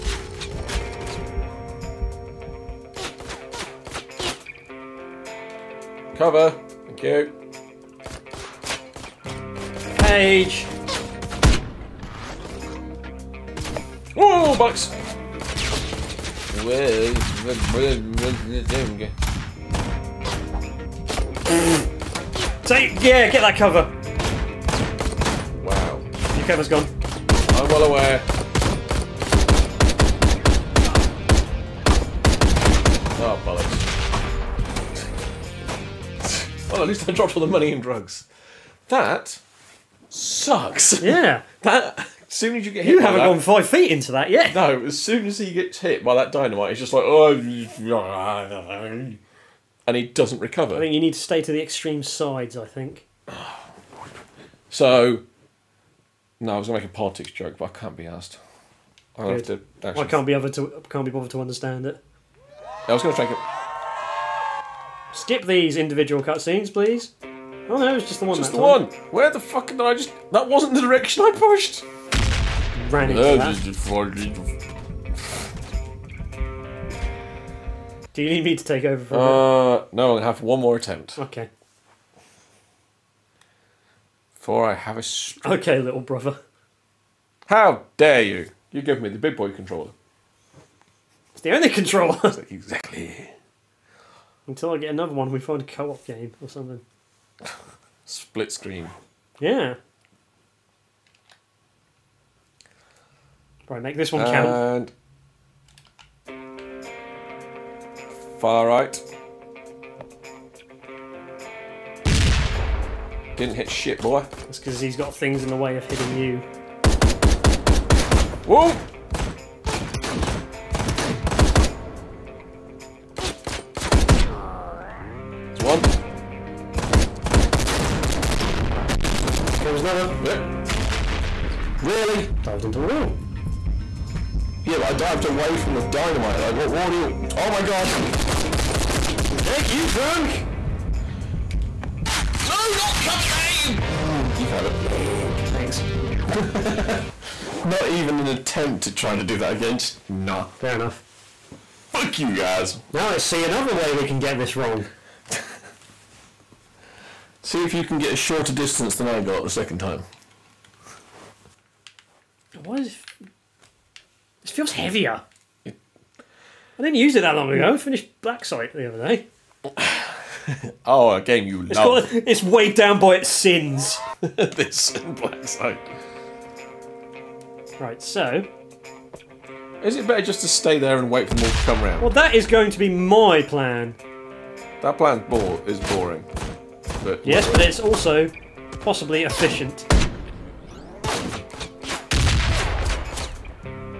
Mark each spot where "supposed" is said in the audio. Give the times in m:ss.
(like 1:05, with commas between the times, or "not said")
not said.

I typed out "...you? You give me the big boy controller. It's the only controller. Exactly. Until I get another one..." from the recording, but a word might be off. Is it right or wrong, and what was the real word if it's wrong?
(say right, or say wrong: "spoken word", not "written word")
right.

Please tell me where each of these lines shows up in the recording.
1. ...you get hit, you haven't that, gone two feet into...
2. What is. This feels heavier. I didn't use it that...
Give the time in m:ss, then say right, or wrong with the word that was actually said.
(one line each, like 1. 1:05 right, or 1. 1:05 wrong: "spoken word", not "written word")
1. 0:42 wrong: "five", not "two"
2. 2:42 right.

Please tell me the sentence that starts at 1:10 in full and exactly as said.
That wasn't the direction I pushed.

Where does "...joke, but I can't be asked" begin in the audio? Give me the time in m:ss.
0:57.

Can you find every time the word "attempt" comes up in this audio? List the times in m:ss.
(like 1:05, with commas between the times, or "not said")
1:20, 2:28.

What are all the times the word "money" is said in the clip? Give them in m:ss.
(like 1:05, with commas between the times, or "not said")
0:37.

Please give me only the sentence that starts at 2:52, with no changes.
called, it's weighed down by its sins.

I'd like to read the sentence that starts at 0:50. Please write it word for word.
I think you need to stay to the extreme sides.